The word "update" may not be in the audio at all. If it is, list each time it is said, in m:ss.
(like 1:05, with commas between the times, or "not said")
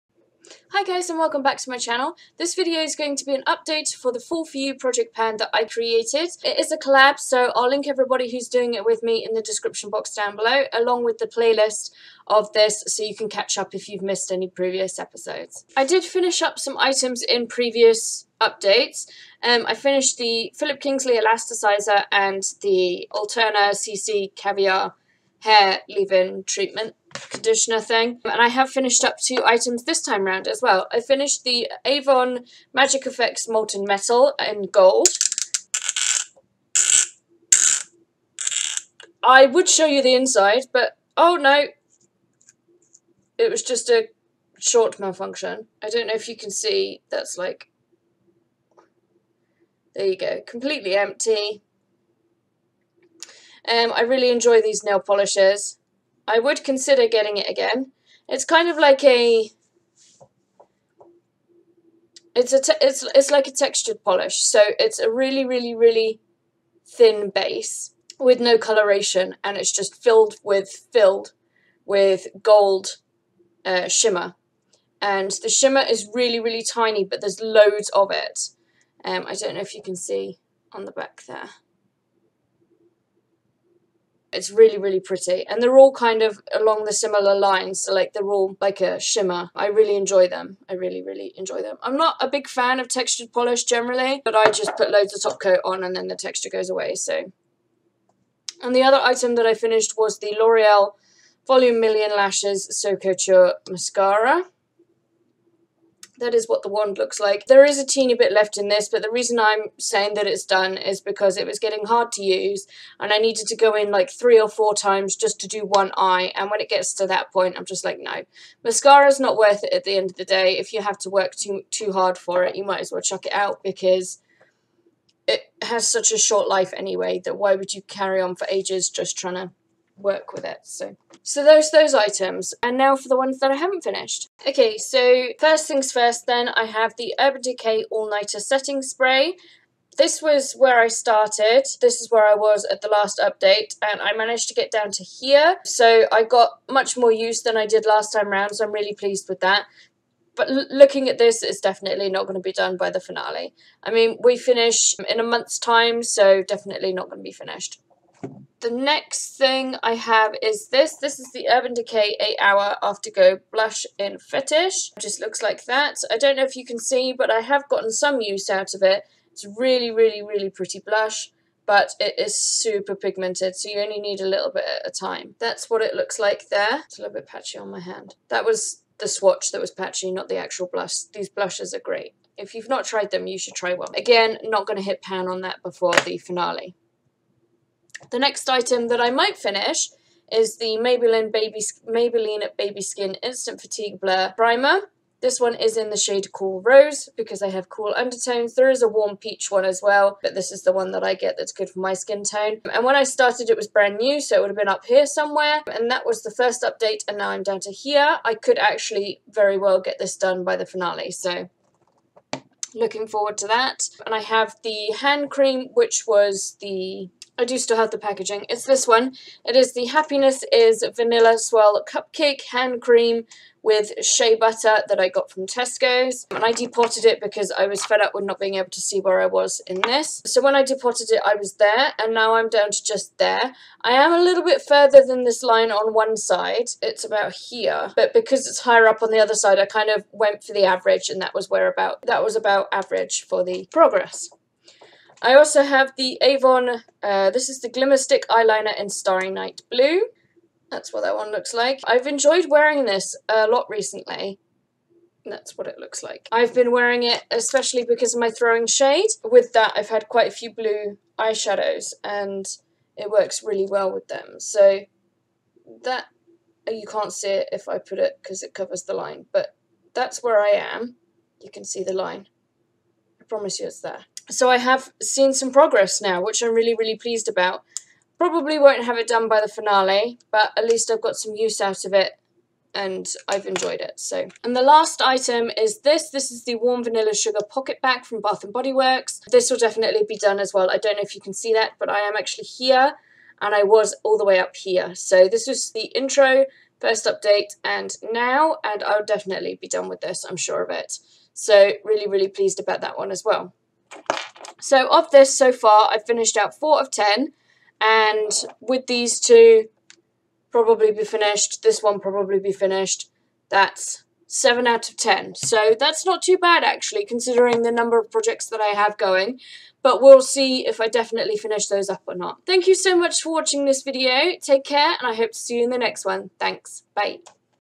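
0:03, 0:18, 2:23, 3:26, 4:57.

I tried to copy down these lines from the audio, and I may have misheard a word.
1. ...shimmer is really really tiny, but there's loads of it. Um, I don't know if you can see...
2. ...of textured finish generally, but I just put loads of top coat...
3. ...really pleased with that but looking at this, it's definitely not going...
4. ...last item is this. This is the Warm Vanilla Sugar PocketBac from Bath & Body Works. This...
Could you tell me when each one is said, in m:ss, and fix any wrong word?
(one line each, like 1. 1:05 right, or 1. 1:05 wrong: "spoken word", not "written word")
1. 1:15 right
2. 1:32 wrong: "polish", not "finish"
3. 2:28 right
4. 4:44 right.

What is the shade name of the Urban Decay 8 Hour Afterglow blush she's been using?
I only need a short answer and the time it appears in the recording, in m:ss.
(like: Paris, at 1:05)
Fetish, at 2:44.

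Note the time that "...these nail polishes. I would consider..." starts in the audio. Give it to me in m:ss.
0:54.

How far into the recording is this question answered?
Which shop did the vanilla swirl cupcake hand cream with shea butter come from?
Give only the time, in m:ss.
3:45.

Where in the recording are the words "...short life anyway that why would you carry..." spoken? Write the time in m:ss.
2:06.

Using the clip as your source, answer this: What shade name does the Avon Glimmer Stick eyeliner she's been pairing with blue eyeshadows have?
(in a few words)
Starry Night Blue.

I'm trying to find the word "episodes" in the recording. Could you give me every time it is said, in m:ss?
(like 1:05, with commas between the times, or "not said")
0:14.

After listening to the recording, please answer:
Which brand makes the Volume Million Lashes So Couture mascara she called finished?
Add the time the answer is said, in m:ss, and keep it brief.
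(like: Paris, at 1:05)
L'Oreal, at 1:40.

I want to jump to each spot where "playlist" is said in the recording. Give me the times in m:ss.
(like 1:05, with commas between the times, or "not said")
0:11.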